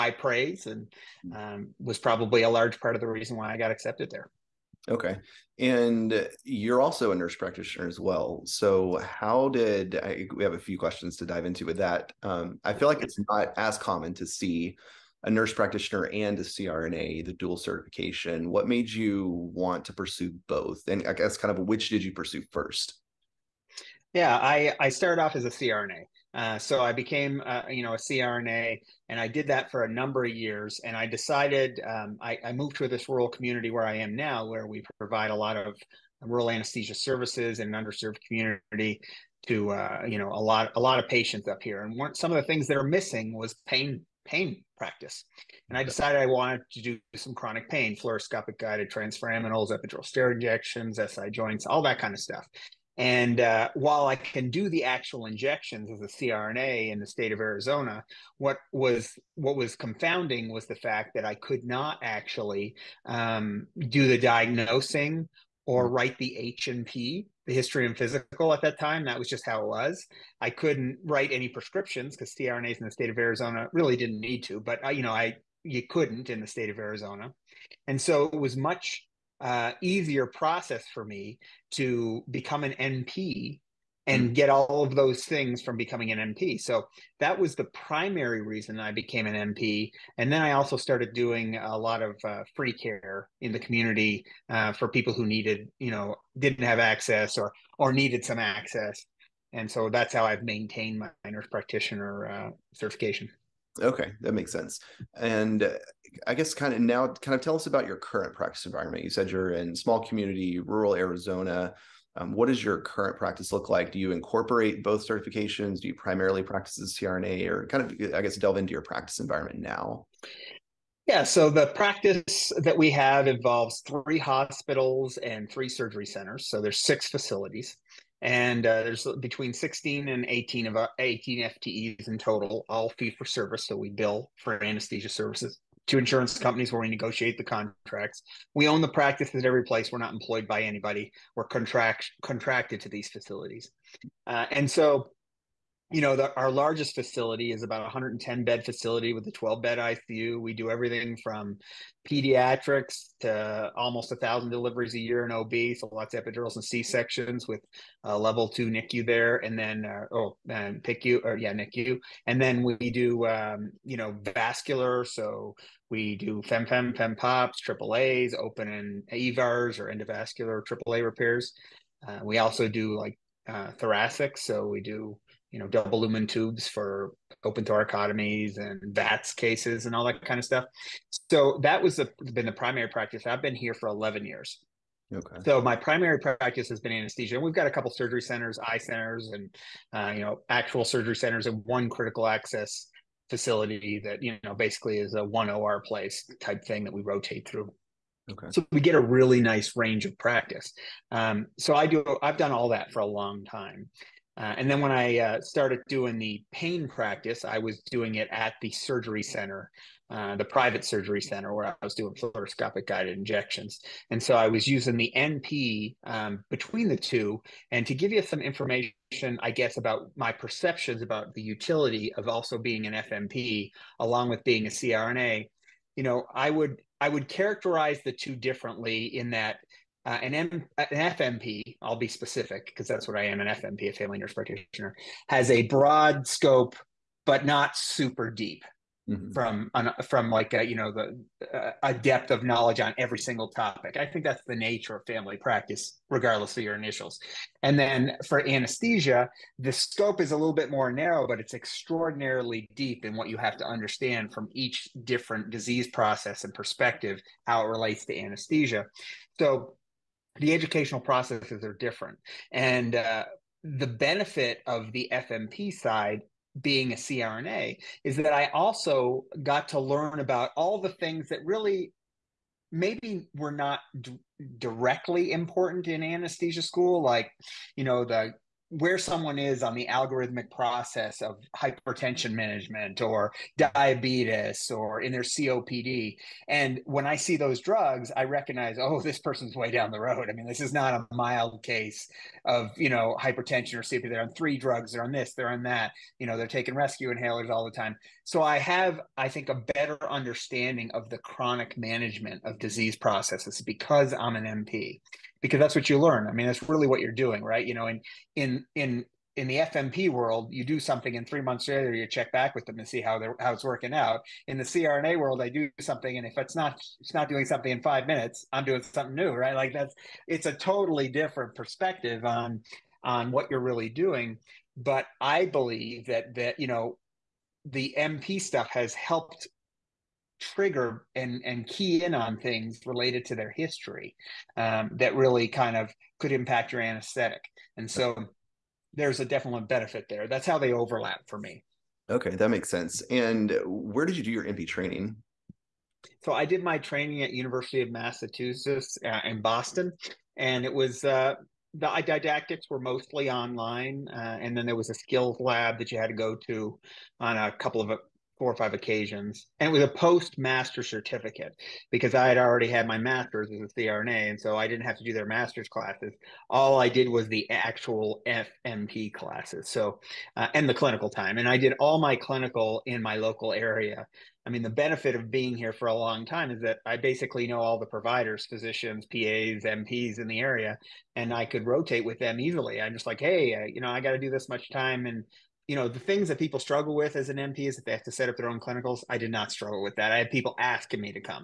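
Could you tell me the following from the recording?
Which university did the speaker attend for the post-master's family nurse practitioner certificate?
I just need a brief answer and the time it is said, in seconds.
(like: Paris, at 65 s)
University of Massachusetts, at 347 s.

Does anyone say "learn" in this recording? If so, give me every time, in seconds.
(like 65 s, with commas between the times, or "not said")
269 s, 305 s.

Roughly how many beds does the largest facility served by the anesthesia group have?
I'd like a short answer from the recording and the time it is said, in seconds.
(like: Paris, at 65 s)
110, at 147 s.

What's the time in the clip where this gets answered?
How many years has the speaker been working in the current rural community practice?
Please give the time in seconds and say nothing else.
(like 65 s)
183 s.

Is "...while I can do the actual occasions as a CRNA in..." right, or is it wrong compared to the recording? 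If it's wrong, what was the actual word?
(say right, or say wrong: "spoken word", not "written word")
wrong: "injections", not "occasions".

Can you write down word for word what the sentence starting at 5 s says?
And you're also a nurse practitioner as well.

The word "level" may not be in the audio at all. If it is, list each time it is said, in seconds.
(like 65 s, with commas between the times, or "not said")
158 s.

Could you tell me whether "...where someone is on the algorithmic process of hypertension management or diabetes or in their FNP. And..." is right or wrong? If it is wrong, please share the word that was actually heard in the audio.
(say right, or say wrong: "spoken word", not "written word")
wrong: "COPD", not "FNP".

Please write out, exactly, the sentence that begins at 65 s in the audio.
write the H and P, the history and physical at that time.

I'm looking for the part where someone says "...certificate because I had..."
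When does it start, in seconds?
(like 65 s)
360 s.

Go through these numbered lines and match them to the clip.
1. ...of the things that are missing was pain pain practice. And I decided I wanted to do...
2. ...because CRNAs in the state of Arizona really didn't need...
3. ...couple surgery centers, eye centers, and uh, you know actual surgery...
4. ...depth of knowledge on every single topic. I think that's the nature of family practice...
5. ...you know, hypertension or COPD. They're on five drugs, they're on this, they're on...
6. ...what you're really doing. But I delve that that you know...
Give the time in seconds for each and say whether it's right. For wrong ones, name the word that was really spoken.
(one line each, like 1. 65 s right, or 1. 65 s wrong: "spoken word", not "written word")
1. 42 s right
2. 72 s right
3. 187 s right
4. 241 s right
5. 292 s wrong: "three", not "five"
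6. 323 s wrong: "believe", not "delve".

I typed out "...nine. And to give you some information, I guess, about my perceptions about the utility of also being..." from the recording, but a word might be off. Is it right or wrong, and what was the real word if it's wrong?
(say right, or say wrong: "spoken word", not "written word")
wrong: "two", not "nine".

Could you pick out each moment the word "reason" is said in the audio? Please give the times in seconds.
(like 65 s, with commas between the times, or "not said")
3 s, 88 s.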